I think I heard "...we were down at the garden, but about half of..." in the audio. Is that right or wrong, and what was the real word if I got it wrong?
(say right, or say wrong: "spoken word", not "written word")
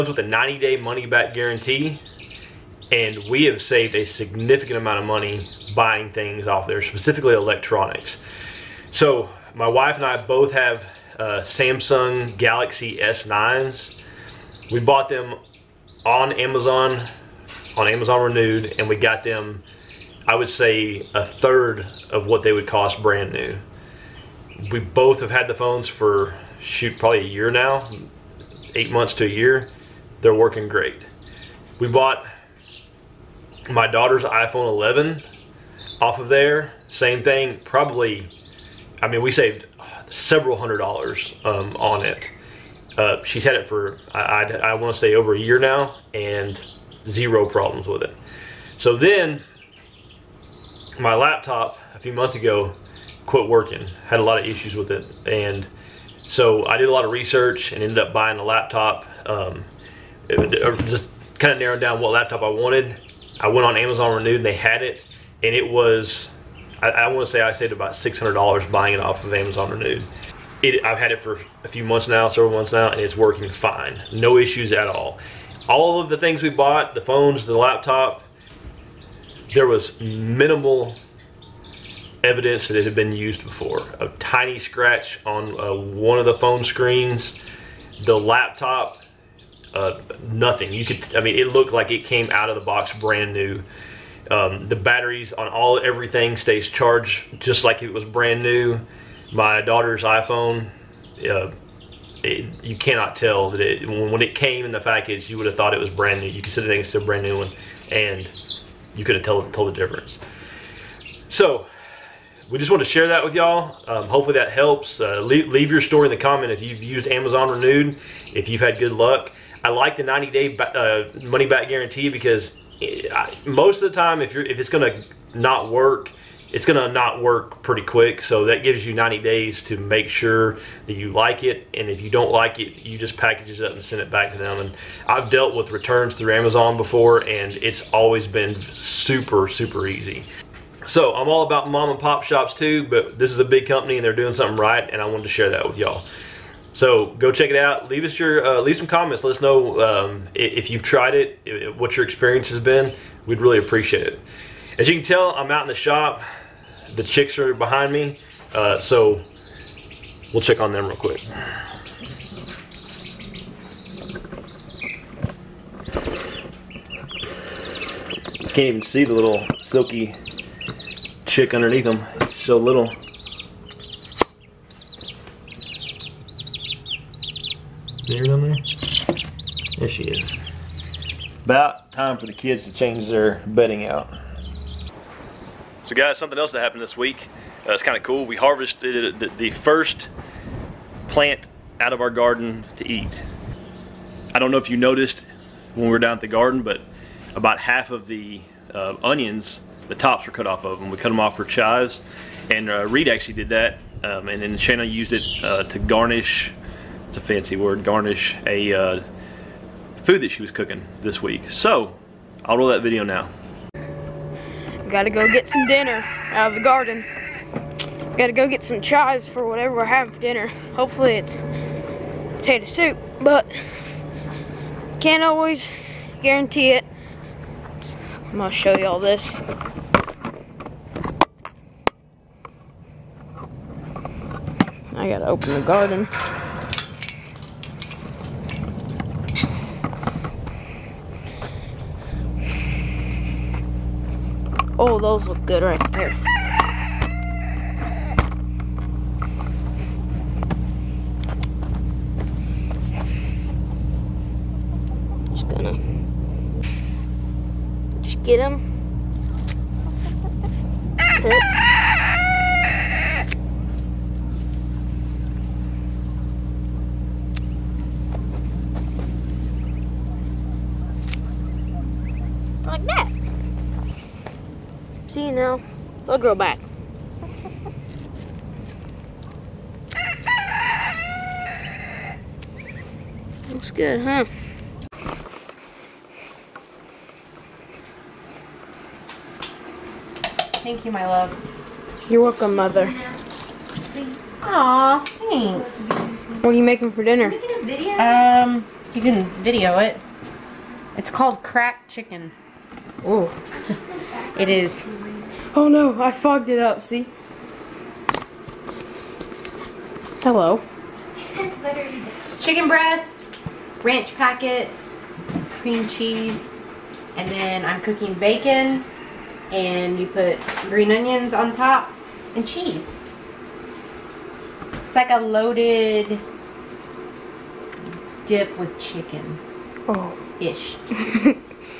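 right.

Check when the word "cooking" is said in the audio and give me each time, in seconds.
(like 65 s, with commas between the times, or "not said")
210 s, 317 s.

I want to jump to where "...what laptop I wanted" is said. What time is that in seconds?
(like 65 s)
62 s.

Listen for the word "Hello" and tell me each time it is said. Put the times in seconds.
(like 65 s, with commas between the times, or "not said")
310 s.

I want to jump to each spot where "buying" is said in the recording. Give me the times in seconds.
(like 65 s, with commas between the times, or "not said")
5 s, 58 s, 68 s.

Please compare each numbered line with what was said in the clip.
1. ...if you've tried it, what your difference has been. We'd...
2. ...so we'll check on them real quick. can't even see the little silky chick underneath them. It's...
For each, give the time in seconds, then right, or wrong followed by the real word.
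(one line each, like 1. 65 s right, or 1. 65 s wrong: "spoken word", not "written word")
1. 150 s wrong: "experience", not "difference"
2. 158 s right.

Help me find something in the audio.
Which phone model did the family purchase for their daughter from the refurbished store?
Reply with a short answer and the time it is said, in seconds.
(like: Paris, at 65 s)
iPhone 11, at 34 s.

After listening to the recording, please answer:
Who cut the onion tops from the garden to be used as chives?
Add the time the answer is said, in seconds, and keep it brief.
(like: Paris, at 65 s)
Reed, at 202 s.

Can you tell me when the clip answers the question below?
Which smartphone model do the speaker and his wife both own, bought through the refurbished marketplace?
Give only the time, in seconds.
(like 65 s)
11 s.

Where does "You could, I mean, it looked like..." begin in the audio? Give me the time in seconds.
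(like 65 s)
90 s.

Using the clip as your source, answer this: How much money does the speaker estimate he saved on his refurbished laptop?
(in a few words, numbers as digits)
$600.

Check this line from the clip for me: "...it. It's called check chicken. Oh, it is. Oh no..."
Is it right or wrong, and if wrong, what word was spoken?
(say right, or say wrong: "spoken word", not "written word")
wrong: "crack", not "check".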